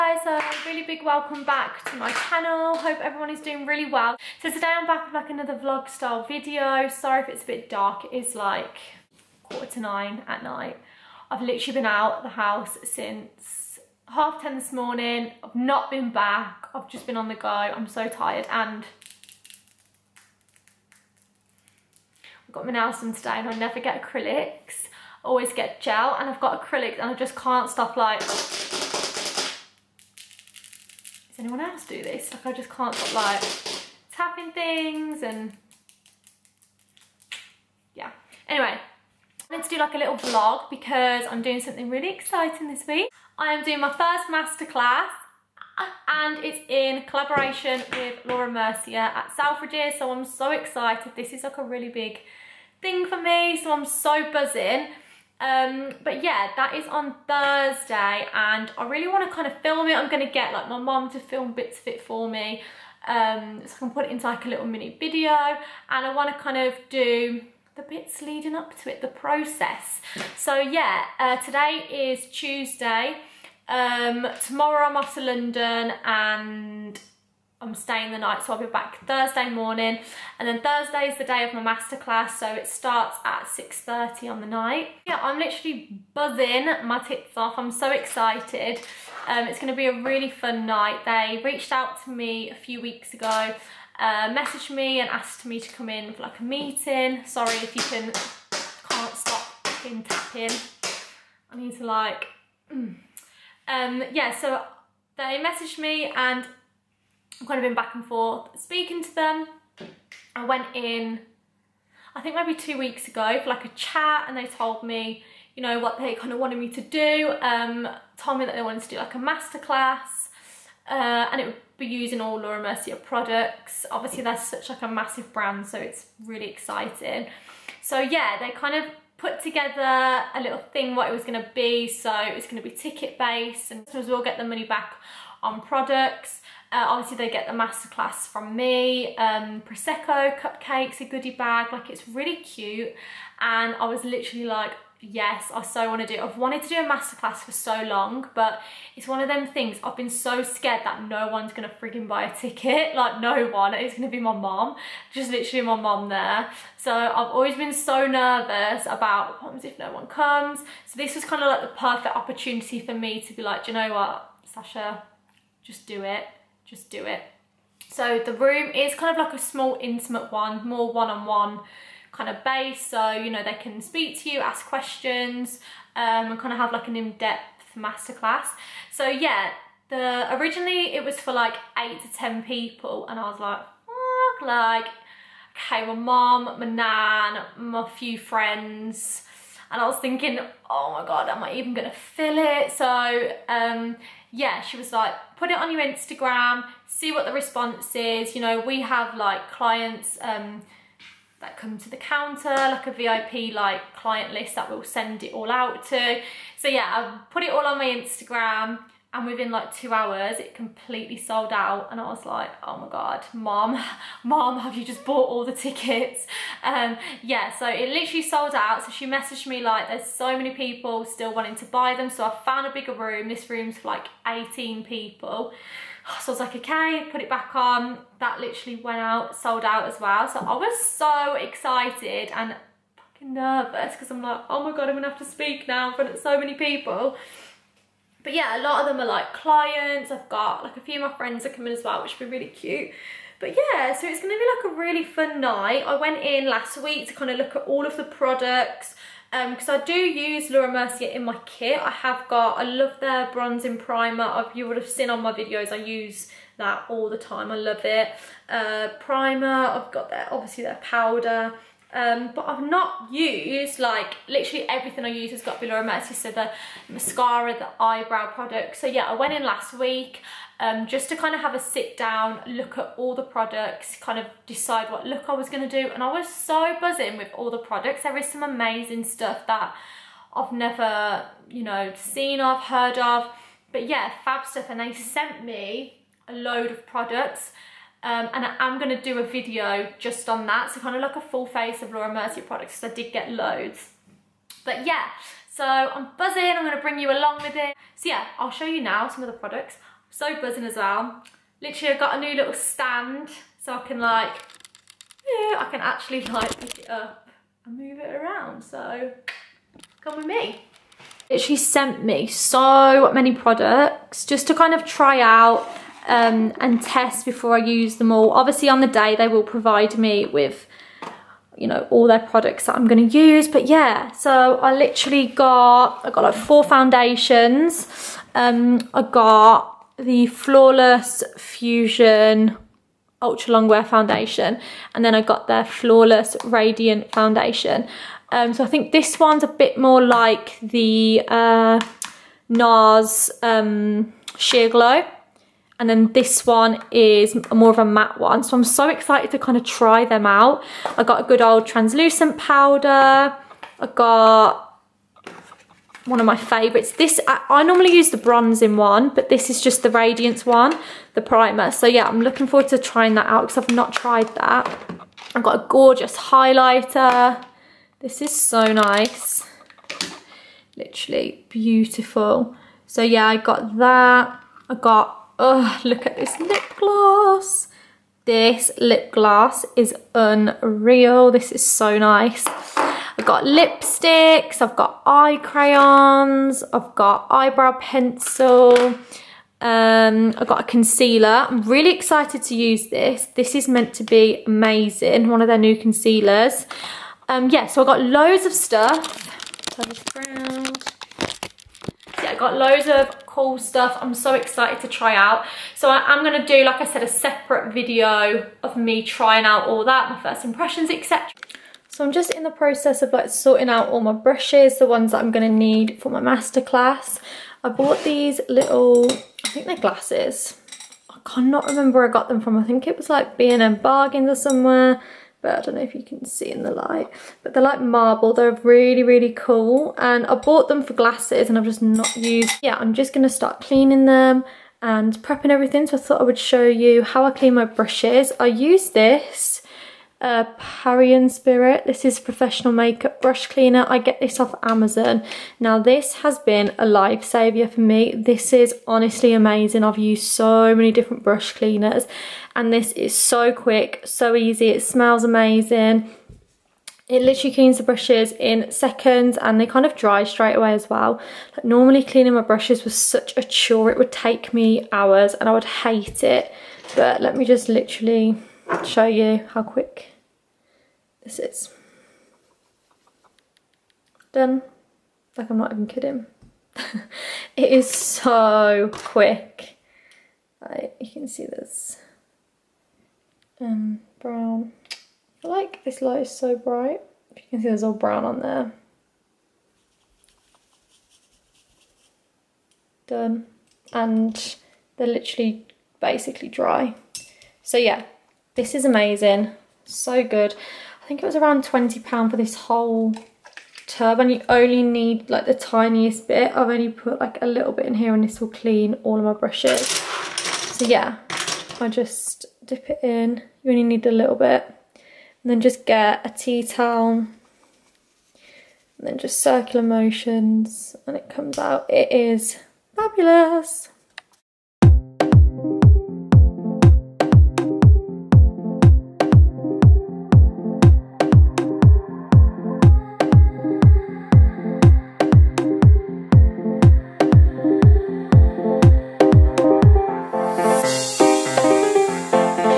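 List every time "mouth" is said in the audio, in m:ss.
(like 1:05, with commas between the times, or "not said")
not said.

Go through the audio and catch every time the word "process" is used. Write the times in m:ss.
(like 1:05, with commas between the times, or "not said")
1:09, 6:52.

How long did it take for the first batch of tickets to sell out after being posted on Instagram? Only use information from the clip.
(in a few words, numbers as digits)
2 hours.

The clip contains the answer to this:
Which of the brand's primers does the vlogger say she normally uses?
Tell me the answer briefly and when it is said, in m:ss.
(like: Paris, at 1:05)
Bronzing primer, at 4:13.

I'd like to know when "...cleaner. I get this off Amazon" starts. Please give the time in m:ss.
7:23.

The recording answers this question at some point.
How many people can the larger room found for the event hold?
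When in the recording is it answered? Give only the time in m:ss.
3:44.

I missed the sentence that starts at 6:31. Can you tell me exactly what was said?
I'm really excited to use this.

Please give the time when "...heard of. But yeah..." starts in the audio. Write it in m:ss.
4:42.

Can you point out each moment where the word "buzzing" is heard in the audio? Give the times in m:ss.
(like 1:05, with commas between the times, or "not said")
0:54, 1:26, 4:36, 4:56, 5:00.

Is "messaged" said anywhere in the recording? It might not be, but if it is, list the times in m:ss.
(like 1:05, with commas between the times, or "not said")
1:34, 1:45, 3:39.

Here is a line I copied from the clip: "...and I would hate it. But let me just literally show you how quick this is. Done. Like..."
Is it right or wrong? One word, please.
right.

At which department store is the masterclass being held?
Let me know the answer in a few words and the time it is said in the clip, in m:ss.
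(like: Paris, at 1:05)
Selfridges, at 0:49.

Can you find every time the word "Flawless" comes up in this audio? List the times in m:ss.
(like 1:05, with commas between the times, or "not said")
5:30, 5:35.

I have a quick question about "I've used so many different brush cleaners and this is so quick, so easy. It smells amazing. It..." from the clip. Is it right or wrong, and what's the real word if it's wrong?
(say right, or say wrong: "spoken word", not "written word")
right.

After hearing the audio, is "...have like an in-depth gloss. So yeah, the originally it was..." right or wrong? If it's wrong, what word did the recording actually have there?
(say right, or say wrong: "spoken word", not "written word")
wrong: "masterclass", not "gloss".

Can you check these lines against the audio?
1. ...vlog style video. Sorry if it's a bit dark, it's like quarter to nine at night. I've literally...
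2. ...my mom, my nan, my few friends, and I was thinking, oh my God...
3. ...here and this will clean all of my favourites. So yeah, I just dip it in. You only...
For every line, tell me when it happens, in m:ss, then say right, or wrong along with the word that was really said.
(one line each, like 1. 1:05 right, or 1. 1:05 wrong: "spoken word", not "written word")
1. 0:05 right
2. 3:05 right
3. 8:27 wrong: "brushes", not "favourites".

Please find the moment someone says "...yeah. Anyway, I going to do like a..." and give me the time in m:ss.
0:37.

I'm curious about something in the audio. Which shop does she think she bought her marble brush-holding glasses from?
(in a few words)
B&M Bargains.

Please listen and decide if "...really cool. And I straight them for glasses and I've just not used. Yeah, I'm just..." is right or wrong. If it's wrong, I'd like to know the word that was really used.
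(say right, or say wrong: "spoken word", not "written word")
wrong: "bought", not "straight".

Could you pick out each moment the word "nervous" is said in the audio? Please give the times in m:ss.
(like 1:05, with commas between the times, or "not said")
2:38, 3:53.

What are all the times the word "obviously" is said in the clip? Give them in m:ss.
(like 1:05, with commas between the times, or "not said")
2:03, 2:16, 4:20, 5:18.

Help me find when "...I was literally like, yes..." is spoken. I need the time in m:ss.
2:23.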